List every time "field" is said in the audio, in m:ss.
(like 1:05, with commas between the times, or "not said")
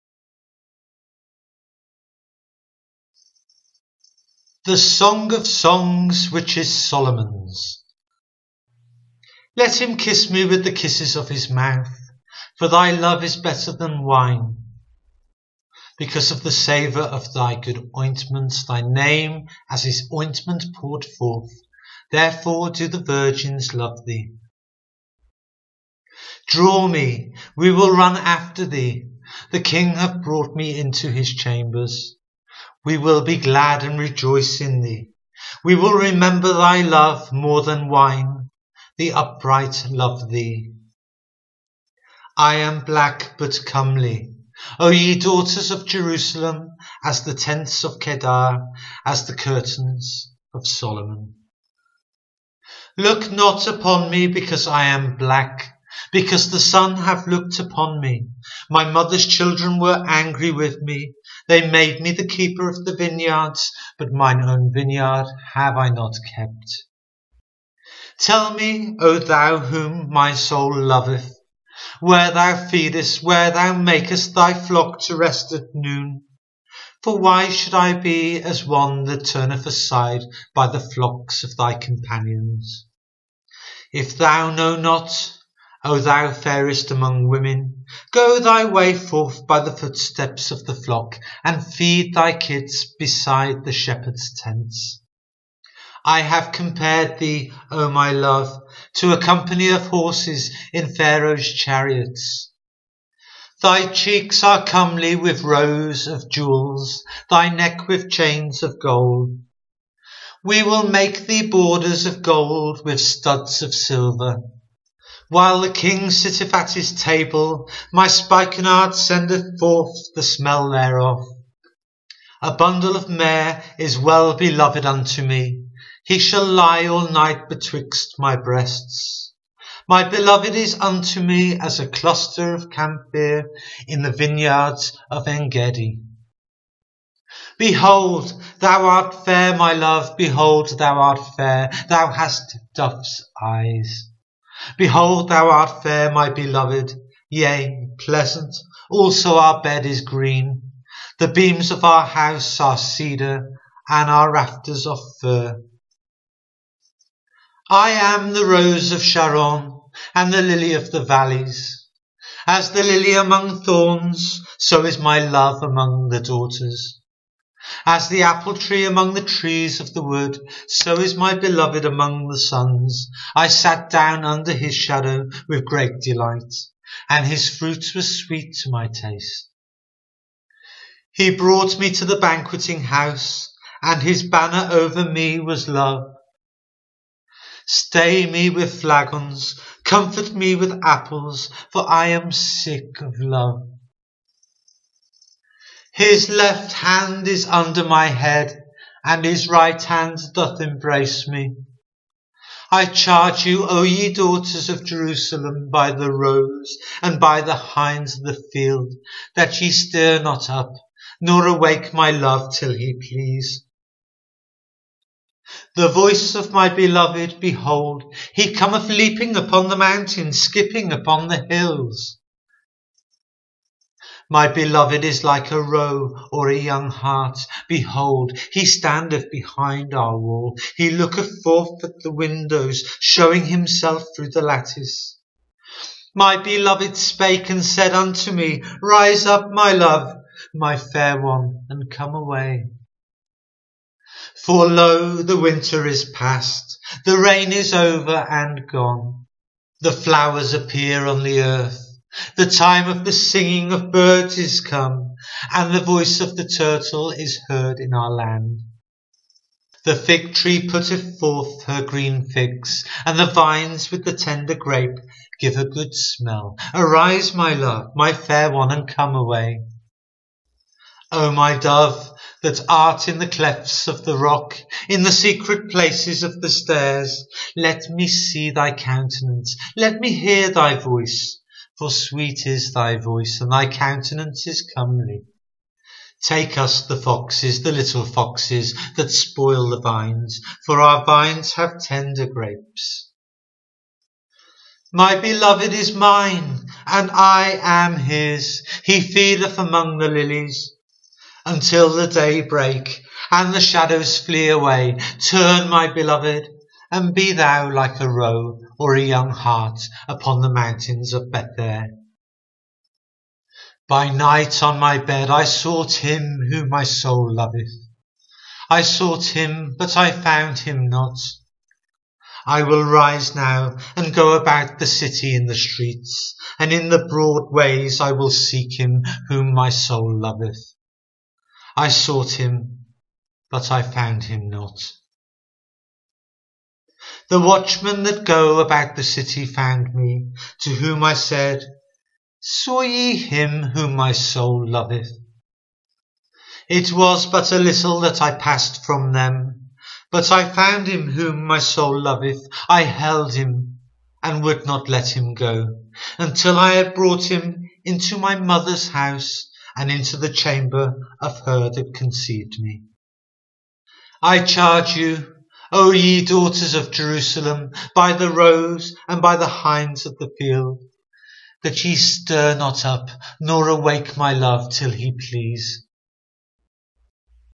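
3:28, 6:10.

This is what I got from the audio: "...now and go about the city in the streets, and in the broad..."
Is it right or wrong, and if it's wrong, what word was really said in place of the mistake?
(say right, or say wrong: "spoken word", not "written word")
right.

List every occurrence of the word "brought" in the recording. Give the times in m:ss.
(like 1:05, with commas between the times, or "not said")
0:30, 3:01, 5:56.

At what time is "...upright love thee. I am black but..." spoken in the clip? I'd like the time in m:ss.
0:39.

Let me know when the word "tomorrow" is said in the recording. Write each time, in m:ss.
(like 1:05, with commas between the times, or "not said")
not said.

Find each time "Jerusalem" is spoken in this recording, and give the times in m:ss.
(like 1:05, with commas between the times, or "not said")
0:45, 3:24, 6:06.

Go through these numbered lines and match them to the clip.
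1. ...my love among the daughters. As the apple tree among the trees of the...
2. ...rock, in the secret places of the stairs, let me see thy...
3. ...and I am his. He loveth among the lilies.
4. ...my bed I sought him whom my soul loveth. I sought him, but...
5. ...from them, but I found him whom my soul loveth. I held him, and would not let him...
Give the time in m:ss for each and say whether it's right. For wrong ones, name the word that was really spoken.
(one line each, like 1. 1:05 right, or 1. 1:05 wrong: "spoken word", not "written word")
1. 2:44 right
2. 4:34 right
3. 4:56 wrong: "feedeth", not "loveth"
4. 5:14 right
5. 5:48 right.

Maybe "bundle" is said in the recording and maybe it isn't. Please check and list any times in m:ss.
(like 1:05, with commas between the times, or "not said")
2:02.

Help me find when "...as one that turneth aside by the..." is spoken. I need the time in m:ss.
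1:18.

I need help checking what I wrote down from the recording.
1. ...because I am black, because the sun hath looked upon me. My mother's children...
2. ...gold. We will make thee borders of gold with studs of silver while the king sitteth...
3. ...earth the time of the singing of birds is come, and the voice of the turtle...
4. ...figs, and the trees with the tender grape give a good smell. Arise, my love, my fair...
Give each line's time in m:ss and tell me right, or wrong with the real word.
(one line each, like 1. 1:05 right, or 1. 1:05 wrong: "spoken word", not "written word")
1. 0:54 right
2. 1:48 right
3. 4:11 right
4. 4:22 wrong: "vines", not "trees".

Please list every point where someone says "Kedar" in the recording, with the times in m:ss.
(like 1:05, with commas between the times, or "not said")
0:47.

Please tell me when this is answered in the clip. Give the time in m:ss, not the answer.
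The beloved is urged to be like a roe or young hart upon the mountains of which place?
5:11.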